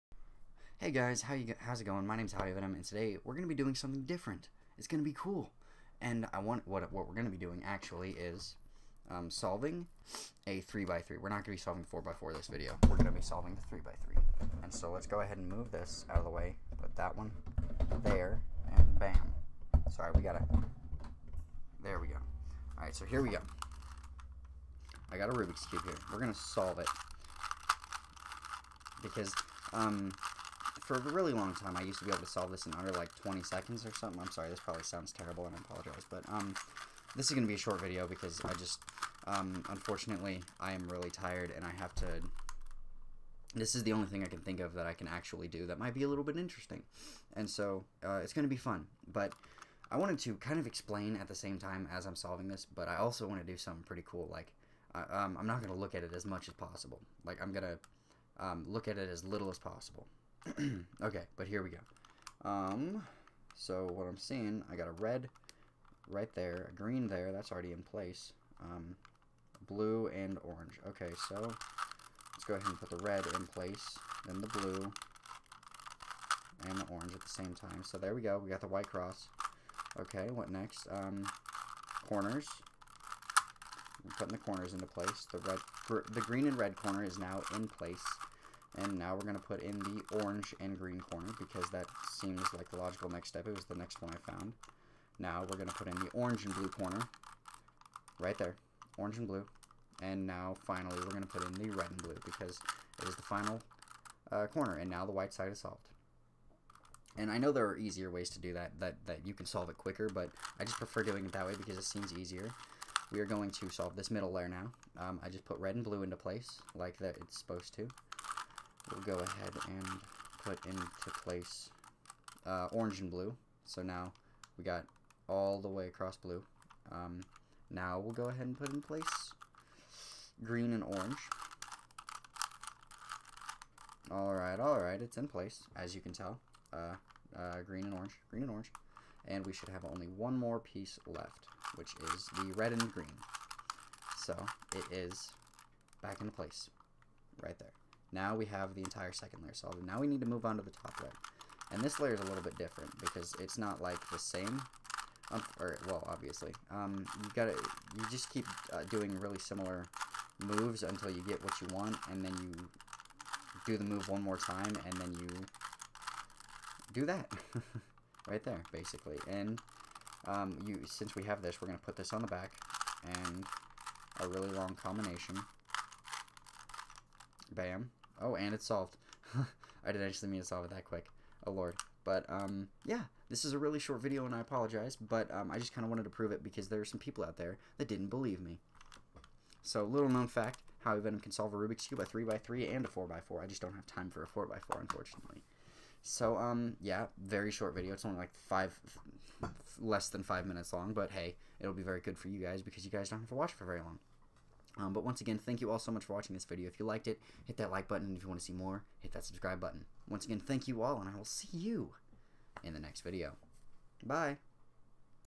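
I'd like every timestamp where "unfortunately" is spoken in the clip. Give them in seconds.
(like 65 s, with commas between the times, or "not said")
39 s, 194 s.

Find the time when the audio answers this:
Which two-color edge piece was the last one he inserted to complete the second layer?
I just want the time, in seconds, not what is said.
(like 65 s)
142 s.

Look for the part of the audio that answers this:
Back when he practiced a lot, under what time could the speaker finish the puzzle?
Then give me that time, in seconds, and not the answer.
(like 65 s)
33 s.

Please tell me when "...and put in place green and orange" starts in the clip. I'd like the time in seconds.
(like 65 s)
128 s.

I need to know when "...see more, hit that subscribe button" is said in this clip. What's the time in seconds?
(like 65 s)
208 s.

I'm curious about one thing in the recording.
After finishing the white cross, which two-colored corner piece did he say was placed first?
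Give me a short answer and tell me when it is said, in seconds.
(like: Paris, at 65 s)
green and red, at 86 s.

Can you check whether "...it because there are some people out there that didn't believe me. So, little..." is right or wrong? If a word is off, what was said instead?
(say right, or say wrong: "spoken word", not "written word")
right.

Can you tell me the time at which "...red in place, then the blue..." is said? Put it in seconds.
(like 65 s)
73 s.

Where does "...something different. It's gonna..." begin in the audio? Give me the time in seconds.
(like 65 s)
3 s.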